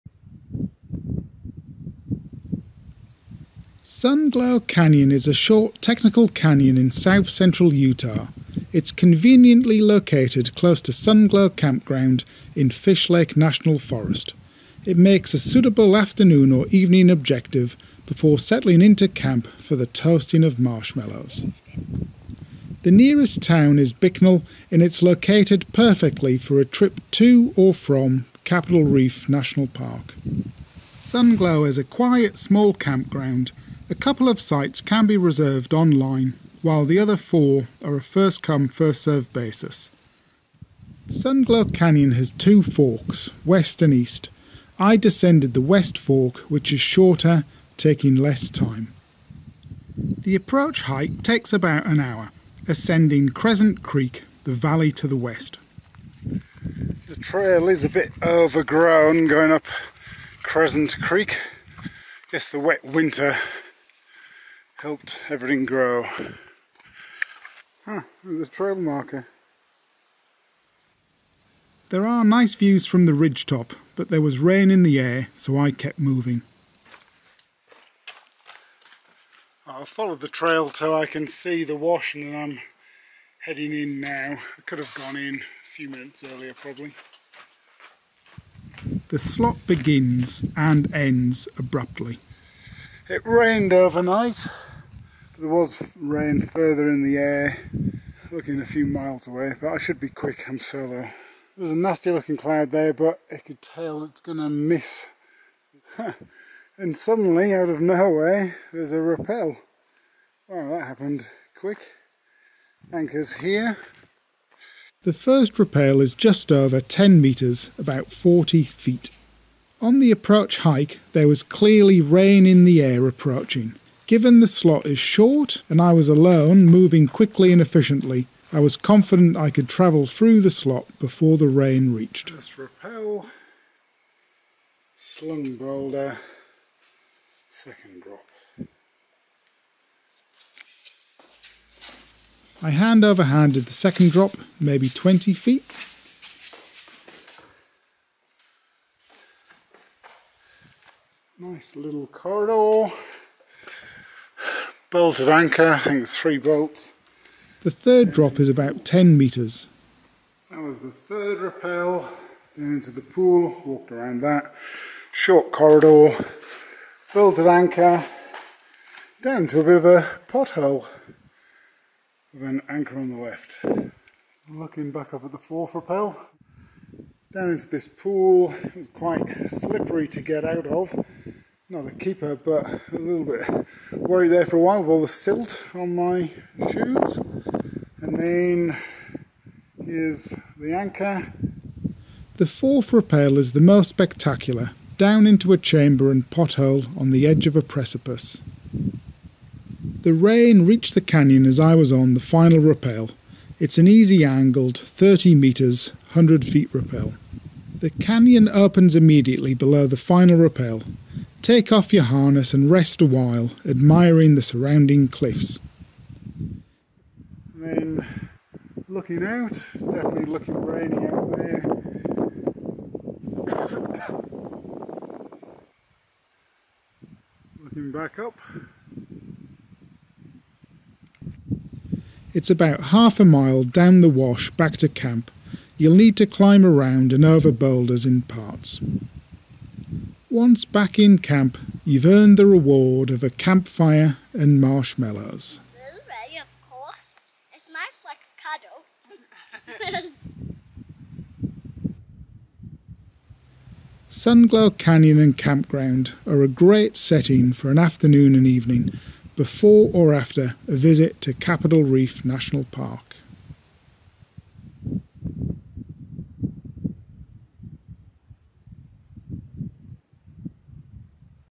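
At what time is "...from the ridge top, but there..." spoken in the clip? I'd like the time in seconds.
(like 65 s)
72 s.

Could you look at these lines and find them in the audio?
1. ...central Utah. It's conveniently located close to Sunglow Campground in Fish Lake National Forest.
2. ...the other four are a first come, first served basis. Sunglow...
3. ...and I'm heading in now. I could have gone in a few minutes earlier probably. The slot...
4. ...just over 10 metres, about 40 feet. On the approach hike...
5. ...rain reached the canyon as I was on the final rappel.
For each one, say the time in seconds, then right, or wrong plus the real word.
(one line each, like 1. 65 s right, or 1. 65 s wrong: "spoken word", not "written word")
1. 7 s right
2. 36 s right
3. 82 s right
4. 116 s right
5. 200 s right.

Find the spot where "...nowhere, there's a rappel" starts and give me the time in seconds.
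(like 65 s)
107 s.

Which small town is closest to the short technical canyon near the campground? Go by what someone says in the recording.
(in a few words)
Bicknell.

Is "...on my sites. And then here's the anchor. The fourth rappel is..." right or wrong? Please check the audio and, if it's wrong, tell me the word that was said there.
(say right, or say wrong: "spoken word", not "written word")
wrong: "shoes", not "sites".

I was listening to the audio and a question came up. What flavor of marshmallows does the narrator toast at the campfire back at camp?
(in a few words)
Blueberry.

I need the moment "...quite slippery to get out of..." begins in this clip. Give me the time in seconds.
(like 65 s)
178 s.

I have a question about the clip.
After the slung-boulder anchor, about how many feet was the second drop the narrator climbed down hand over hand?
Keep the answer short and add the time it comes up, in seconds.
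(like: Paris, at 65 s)
20 feet, at 144 s.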